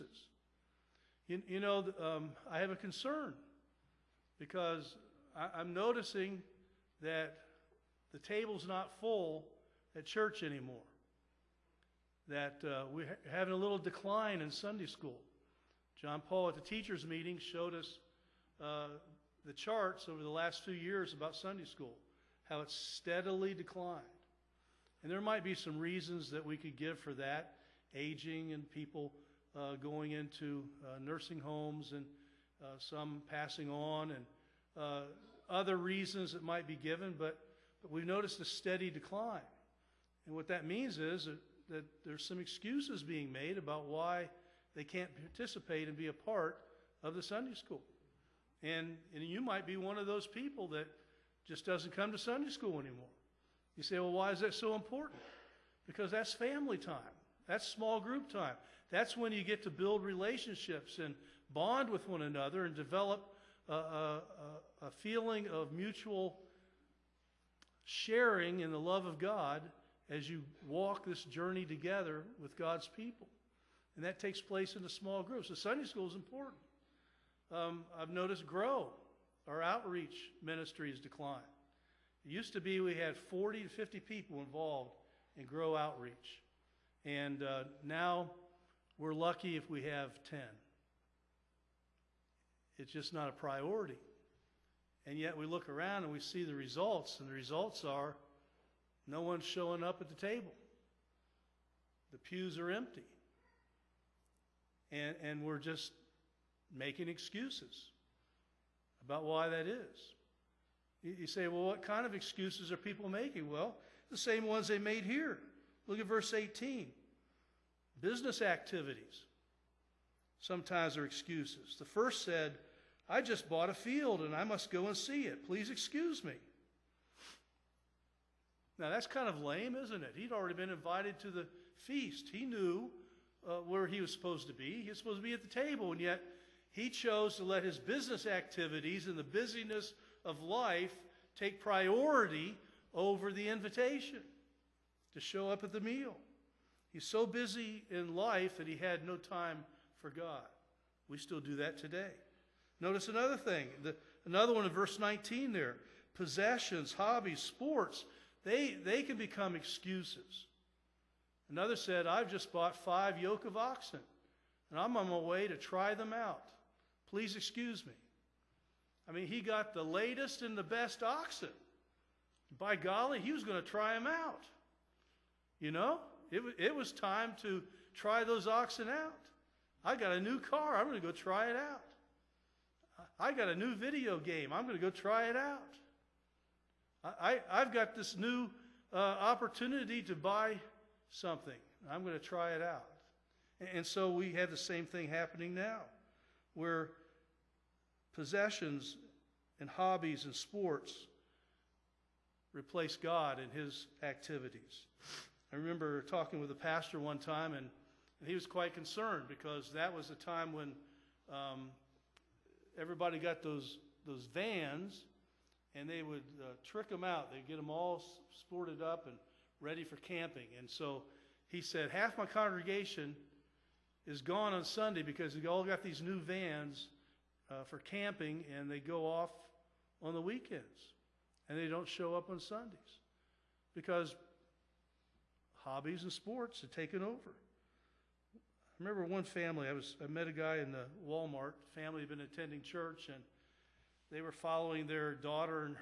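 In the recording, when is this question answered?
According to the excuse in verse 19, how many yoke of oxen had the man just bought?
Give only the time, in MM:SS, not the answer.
02:42.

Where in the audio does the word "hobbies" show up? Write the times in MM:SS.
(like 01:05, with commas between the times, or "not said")
02:36, 03:19, 03:55.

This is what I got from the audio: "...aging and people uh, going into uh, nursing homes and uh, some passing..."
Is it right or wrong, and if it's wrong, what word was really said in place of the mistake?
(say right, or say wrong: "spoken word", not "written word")
right.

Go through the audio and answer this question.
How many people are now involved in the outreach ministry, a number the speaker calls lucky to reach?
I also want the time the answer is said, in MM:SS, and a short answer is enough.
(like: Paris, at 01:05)
10, at 01:30.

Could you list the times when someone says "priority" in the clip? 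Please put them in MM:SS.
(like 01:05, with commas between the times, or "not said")
01:33, 02:21.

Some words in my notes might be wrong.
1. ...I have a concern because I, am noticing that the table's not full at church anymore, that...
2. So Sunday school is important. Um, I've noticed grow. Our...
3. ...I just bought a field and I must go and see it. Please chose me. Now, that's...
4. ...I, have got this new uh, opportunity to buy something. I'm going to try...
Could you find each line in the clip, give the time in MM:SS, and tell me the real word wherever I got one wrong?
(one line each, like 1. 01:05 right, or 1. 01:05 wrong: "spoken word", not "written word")
1. 00:02 right
2. 01:15 right
3. 02:03 wrong: "excuse", not "chose"
4. 03:07 right.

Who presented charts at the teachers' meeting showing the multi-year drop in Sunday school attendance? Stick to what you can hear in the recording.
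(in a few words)
John Paul.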